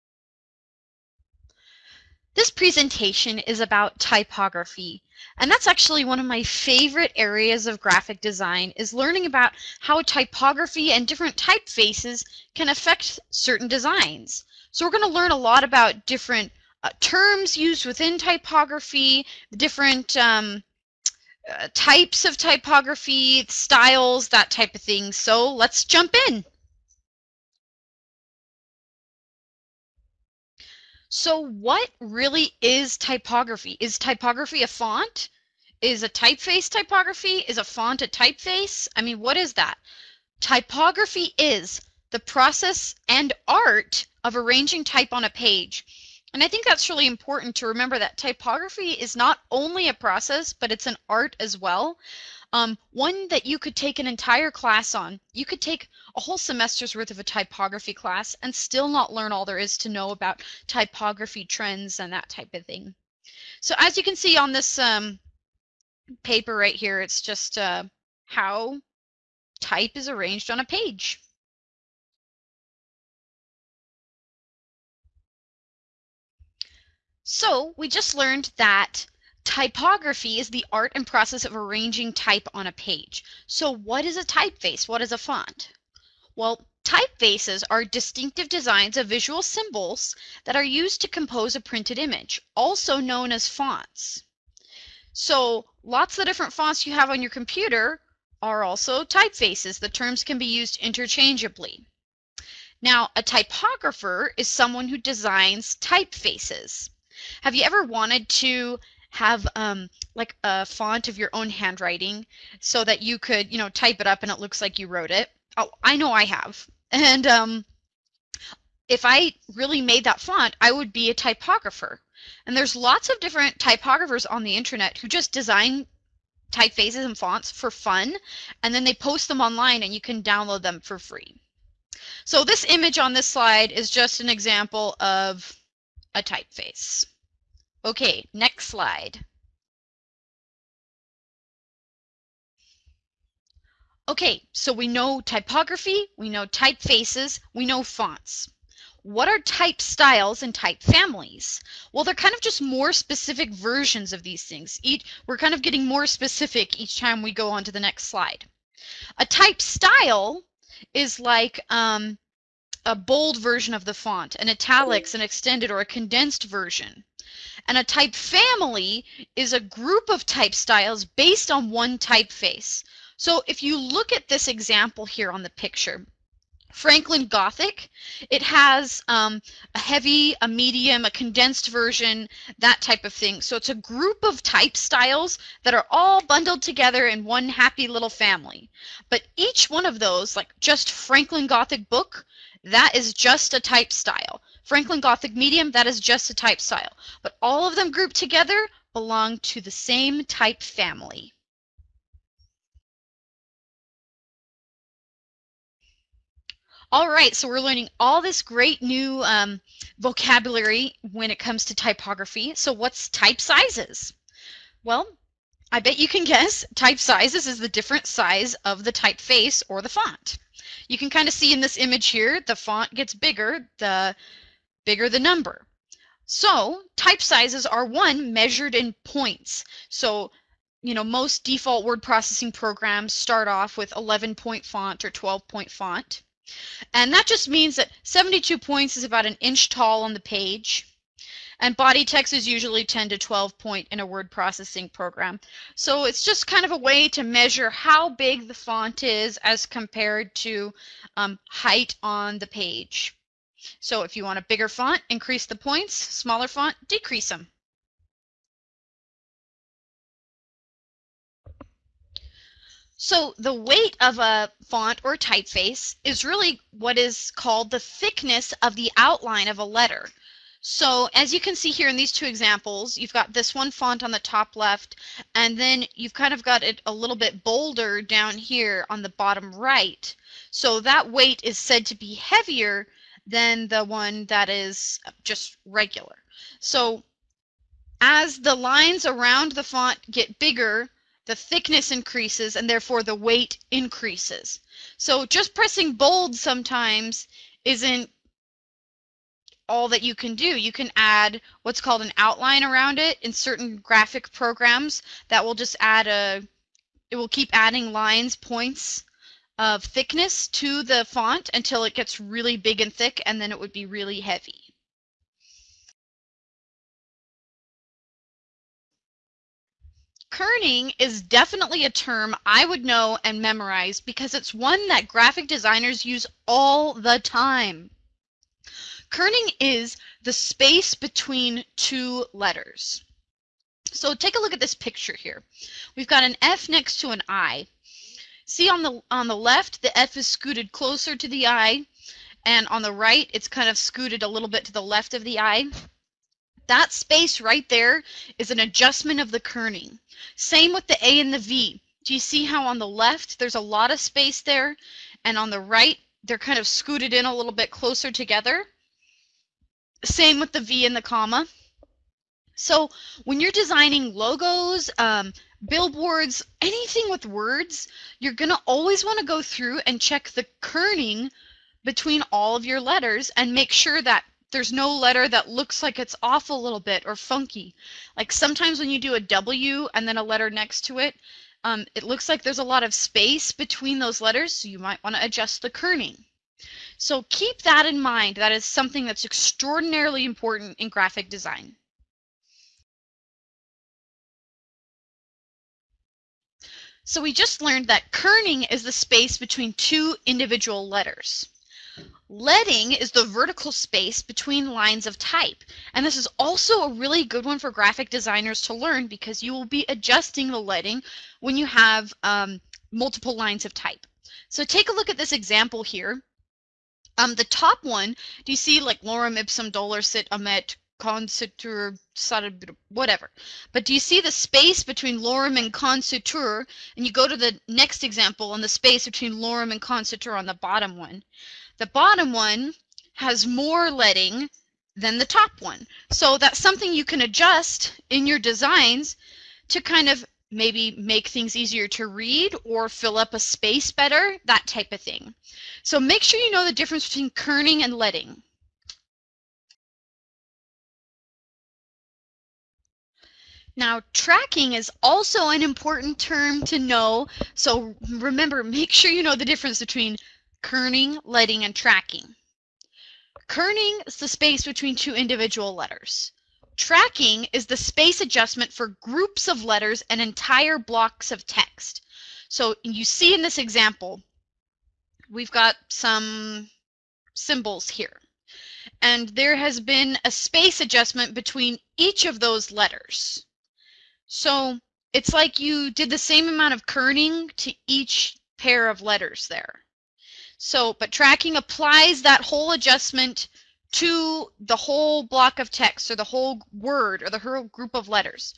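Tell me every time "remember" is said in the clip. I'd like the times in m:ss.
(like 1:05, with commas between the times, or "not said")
0:47, 7:38.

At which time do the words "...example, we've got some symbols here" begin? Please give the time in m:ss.
7:53.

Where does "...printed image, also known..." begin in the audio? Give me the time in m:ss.
1:31.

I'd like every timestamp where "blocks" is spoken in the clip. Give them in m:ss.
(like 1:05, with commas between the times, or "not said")
7:50, 8:15.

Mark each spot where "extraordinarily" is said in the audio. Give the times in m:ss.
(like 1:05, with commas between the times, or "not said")
6:29.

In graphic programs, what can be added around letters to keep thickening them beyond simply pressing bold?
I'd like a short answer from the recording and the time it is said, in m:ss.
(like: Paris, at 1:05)
an outline, at 5:02.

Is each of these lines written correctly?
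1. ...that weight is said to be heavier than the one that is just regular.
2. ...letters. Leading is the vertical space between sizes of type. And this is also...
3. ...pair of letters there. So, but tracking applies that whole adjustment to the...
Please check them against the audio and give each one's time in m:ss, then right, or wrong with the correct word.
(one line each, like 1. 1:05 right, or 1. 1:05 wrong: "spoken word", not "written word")
1. 4:40 right
2. 6:40 wrong: "lines", not "sizes"
3. 8:08 right.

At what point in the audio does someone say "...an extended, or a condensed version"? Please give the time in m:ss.
2:45.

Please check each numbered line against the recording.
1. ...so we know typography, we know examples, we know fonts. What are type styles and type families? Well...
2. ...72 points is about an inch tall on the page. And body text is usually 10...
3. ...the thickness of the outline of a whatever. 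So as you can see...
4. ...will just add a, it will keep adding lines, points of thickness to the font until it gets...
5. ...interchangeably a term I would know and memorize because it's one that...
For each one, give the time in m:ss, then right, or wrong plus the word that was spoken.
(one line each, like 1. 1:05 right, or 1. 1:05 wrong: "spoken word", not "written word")
1. 2:24 wrong: "typefaces", not "examples"
2. 3:58 right
3. 4:27 wrong: "letter", not "whatever"
4. 5:05 right
5. 5:21 wrong: "definitely", not "interchangeably".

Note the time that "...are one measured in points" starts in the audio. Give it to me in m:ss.
3:47.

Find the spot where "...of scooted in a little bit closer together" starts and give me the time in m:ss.
5:56.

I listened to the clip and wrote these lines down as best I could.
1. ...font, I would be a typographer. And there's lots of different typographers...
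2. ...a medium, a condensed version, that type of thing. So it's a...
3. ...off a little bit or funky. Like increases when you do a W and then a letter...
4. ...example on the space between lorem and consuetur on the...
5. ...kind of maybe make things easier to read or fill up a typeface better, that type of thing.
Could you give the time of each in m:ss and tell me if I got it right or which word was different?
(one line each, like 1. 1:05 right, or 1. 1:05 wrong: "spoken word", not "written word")
1. 2:00 right
2. 3:00 right
3. 6:16 wrong: "sometimes", not "increases"
4. 7:08 right
5. 7:19 wrong: "space", not "typeface".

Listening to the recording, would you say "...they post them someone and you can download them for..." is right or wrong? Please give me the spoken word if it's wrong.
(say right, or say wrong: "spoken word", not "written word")
wrong: "online", not "someone".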